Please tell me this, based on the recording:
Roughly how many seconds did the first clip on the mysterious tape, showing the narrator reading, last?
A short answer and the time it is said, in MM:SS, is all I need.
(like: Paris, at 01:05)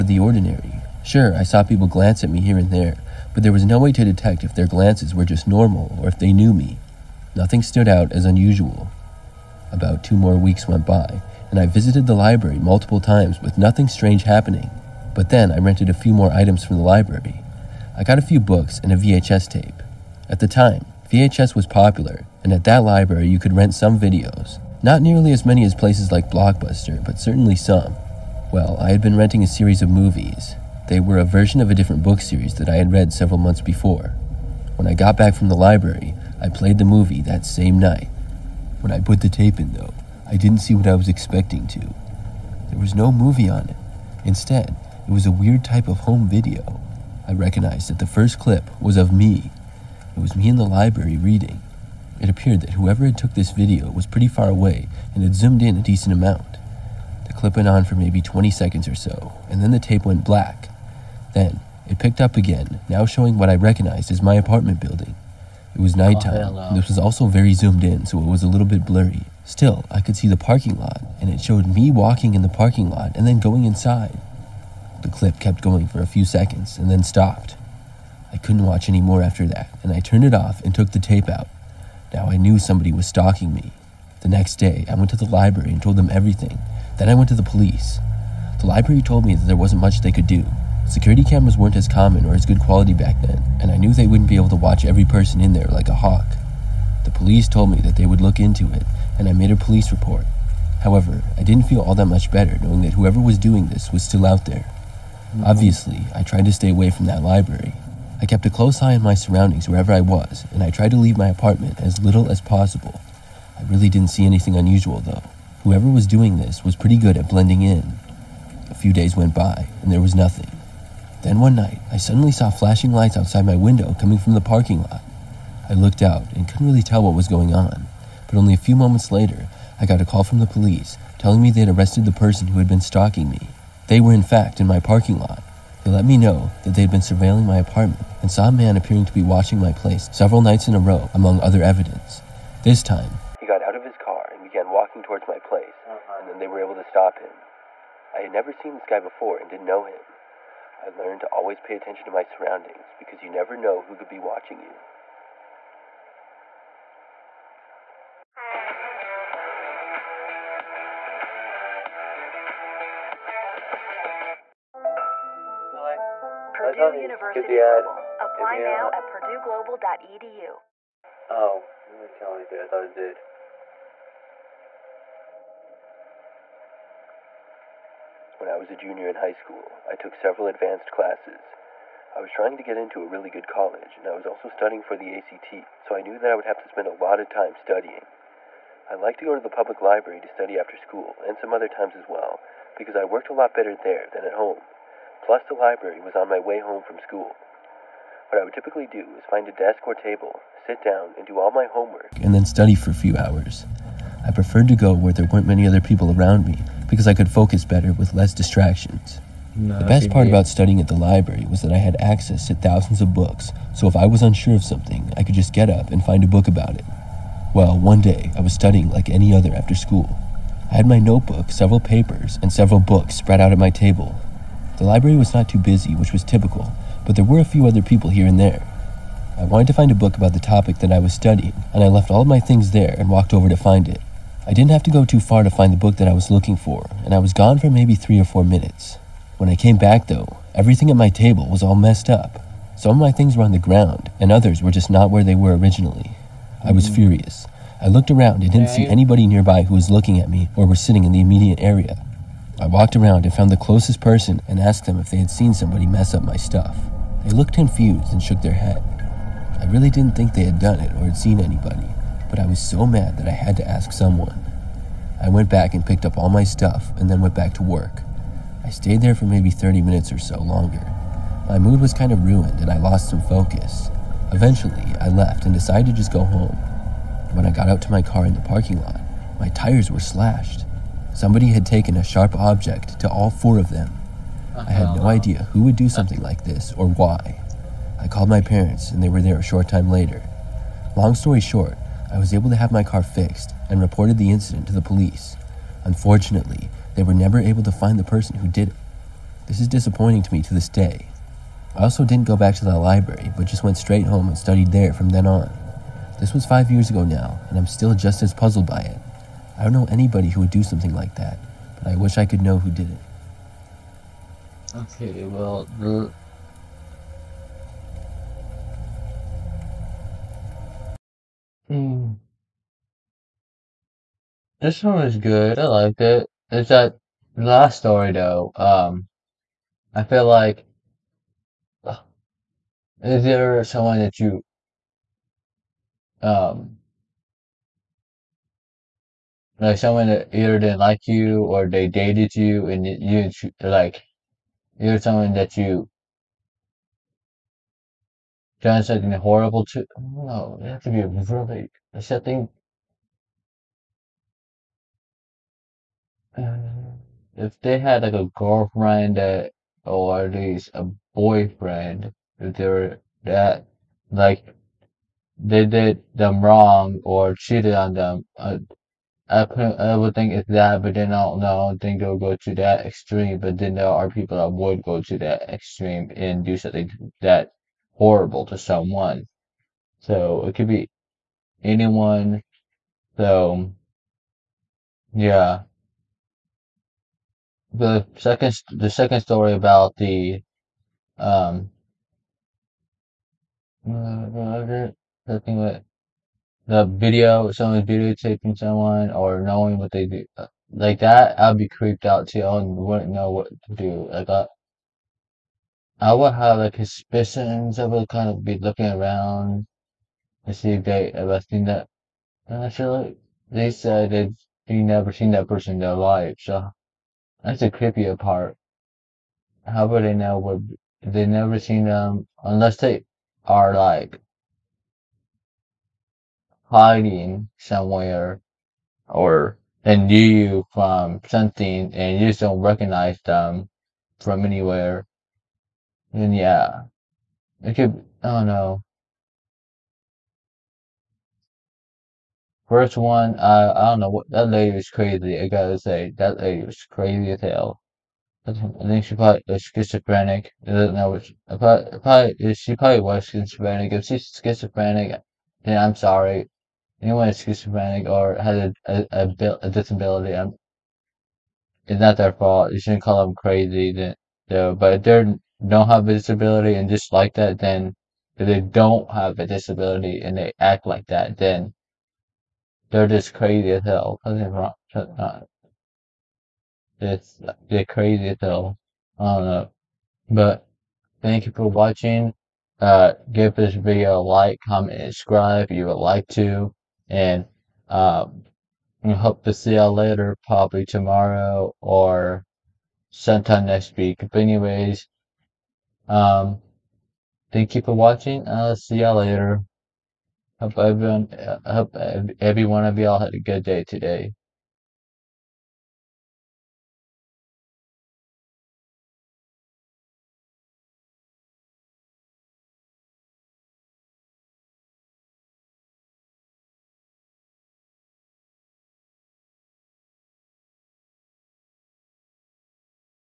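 20, at 00:58.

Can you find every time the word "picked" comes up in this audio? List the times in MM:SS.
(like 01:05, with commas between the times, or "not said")
01:01, 04:25.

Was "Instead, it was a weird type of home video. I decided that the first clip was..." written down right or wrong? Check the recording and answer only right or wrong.
wrong.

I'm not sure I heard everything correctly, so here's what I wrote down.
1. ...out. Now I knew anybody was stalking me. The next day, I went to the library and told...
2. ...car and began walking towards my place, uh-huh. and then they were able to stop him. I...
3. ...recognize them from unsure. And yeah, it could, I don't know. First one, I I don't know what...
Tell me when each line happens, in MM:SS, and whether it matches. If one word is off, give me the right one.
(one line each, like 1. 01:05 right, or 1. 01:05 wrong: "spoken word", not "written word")
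1. 01:21 wrong: "somebody", not "anybody"
2. 02:23 right
3. 07:12 wrong: "anywhere", not "unsure".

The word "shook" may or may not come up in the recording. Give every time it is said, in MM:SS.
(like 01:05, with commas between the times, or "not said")
04:18.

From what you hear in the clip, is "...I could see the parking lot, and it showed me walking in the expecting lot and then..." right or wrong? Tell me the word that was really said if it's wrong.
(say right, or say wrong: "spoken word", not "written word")
wrong: "parking", not "expecting".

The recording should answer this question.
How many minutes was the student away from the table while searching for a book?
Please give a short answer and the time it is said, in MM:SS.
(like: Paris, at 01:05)
three or four, at 03:57.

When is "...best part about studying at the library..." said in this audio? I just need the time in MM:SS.
03:29.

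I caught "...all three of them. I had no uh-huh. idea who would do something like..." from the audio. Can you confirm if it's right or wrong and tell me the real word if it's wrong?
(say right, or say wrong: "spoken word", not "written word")
wrong: "four", not "three".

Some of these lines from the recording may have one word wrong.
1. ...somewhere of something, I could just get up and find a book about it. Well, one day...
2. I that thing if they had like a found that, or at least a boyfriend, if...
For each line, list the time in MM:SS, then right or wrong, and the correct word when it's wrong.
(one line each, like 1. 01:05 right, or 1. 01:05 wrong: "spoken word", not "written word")
1. 03:34 wrong: "unsure", not "somewhere"
2. 05:51 wrong: "girlfriend", not "found".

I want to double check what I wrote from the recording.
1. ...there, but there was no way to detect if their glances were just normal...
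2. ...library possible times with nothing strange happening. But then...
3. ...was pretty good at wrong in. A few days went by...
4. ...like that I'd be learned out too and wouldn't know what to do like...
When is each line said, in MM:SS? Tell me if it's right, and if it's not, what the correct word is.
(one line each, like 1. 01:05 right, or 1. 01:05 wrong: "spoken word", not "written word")
1. 00:02 right
2. 00:12 wrong: "multiple", not "possible"
3. 01:56 wrong: "blending", not "wrong"
4. 06:40 wrong: "creeped", not "learned".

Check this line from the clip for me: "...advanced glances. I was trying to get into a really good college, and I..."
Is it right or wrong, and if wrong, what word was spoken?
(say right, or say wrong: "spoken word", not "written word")
wrong: "classes", not "glances".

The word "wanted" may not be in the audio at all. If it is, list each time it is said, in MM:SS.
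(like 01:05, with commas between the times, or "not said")
03:49.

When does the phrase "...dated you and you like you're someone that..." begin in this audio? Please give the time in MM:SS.
05:41.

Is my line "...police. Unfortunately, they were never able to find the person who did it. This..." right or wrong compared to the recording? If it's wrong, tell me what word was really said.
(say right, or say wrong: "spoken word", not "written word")
right.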